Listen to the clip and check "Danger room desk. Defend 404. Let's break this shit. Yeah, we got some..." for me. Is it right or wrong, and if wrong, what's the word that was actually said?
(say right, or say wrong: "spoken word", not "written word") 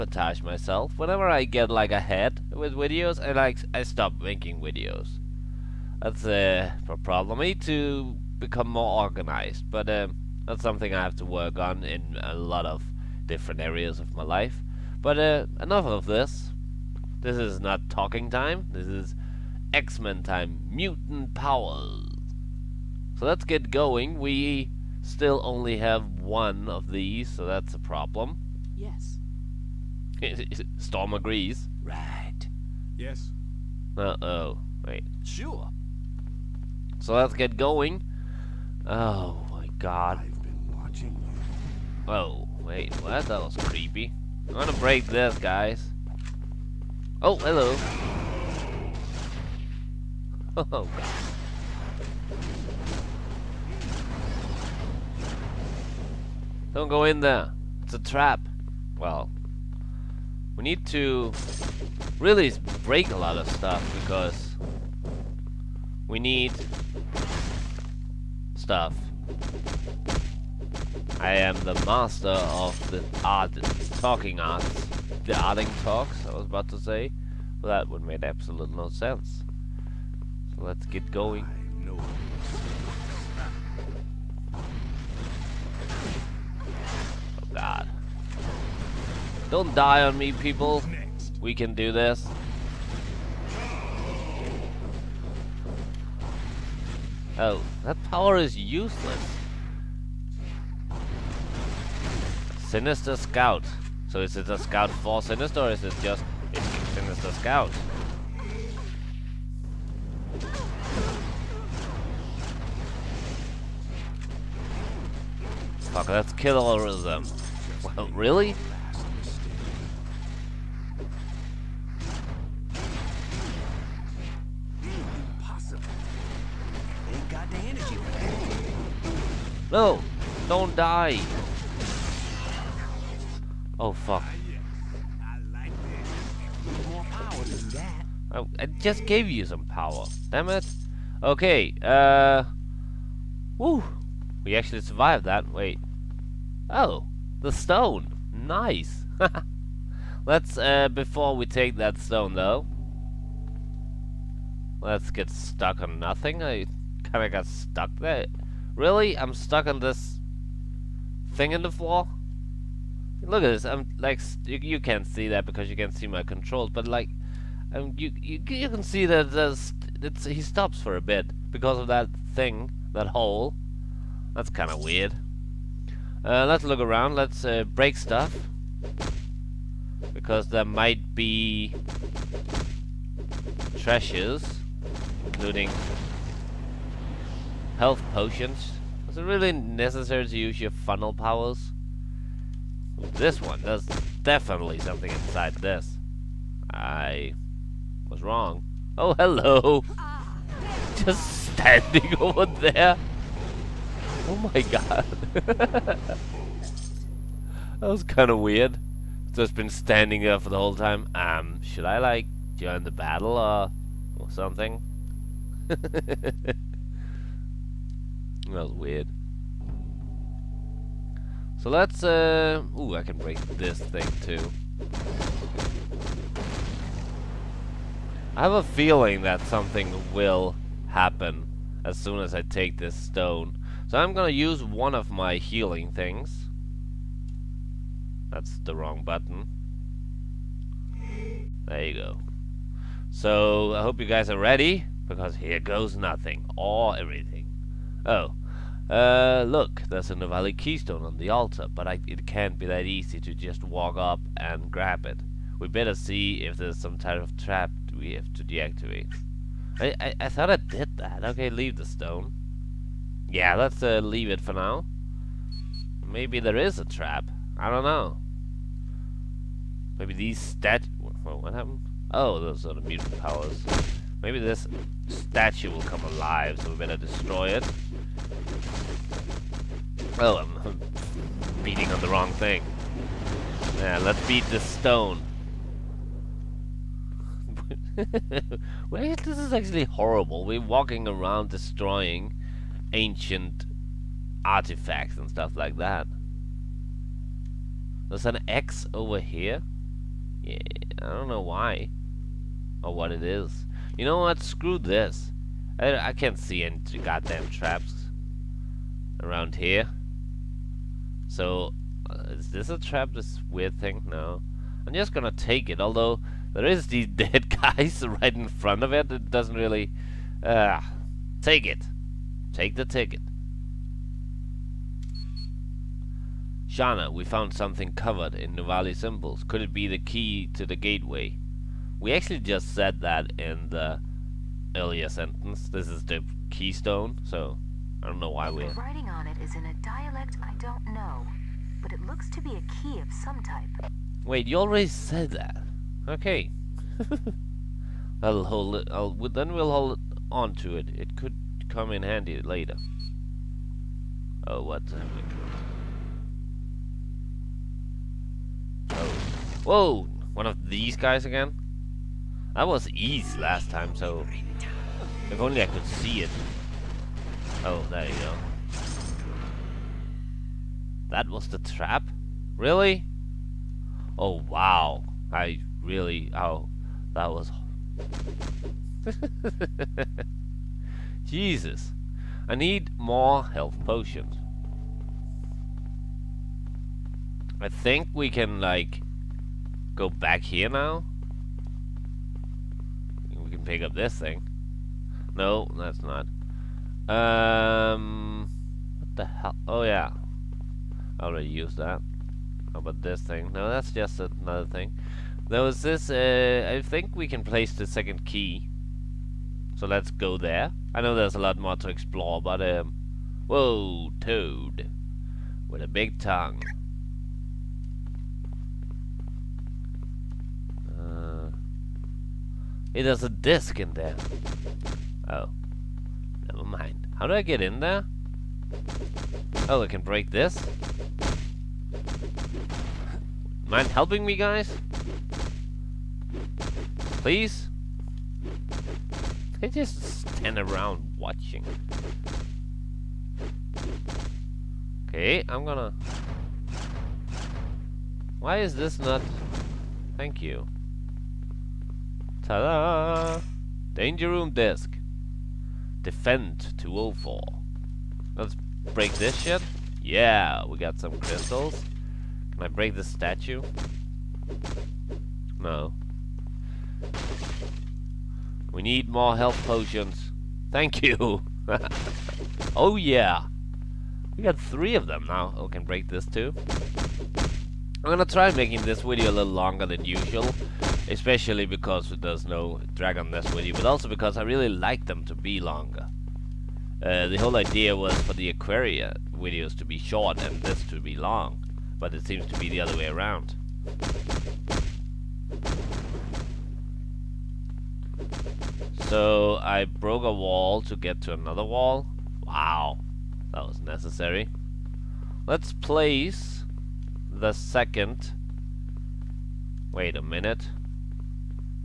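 wrong: "204", not "404".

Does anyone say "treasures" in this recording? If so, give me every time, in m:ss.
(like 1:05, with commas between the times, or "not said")
3:03.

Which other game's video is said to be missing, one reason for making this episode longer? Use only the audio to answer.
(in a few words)
Dragon Nest.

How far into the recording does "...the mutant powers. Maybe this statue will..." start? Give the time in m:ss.
4:32.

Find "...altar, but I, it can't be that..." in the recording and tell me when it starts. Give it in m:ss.
4:11.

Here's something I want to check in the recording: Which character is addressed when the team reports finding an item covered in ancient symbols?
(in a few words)
Shanna.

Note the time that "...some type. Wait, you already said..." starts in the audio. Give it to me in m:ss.
5:43.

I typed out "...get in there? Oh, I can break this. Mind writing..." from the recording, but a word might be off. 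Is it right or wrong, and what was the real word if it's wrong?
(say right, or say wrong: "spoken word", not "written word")
wrong: "helping", not "writing".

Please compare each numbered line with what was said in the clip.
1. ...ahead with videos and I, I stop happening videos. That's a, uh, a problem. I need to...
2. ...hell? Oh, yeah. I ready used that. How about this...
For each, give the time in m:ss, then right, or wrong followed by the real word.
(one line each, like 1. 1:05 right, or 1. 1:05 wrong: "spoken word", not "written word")
1. 0:01 wrong: "making", not "happening"
2. 6:39 wrong: "already", not "ready".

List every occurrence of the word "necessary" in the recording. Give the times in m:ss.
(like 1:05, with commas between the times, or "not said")
3:09, 8:23.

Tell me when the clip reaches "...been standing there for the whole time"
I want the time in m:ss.
3:29.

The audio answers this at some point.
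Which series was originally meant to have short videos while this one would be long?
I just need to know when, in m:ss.
8:08.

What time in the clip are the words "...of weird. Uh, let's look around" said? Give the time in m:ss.
2:54.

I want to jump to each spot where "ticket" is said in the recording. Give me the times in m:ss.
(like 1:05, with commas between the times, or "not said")
5:22.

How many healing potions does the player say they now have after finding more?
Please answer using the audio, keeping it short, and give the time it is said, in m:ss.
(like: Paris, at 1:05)
3, at 7:54.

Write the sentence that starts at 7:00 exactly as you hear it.
Uh, hey, there's a disc in there.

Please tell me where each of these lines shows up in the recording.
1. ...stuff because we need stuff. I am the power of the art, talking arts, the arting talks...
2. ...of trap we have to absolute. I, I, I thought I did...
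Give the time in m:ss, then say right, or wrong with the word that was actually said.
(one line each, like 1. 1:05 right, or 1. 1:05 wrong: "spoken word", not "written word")
1. 1:03 wrong: "master", not "power"
2. 4:17 wrong: "deactivate", not "absolute".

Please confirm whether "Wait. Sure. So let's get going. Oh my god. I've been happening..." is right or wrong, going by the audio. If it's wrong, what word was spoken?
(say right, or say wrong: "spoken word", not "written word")
wrong: "watching", not "happening".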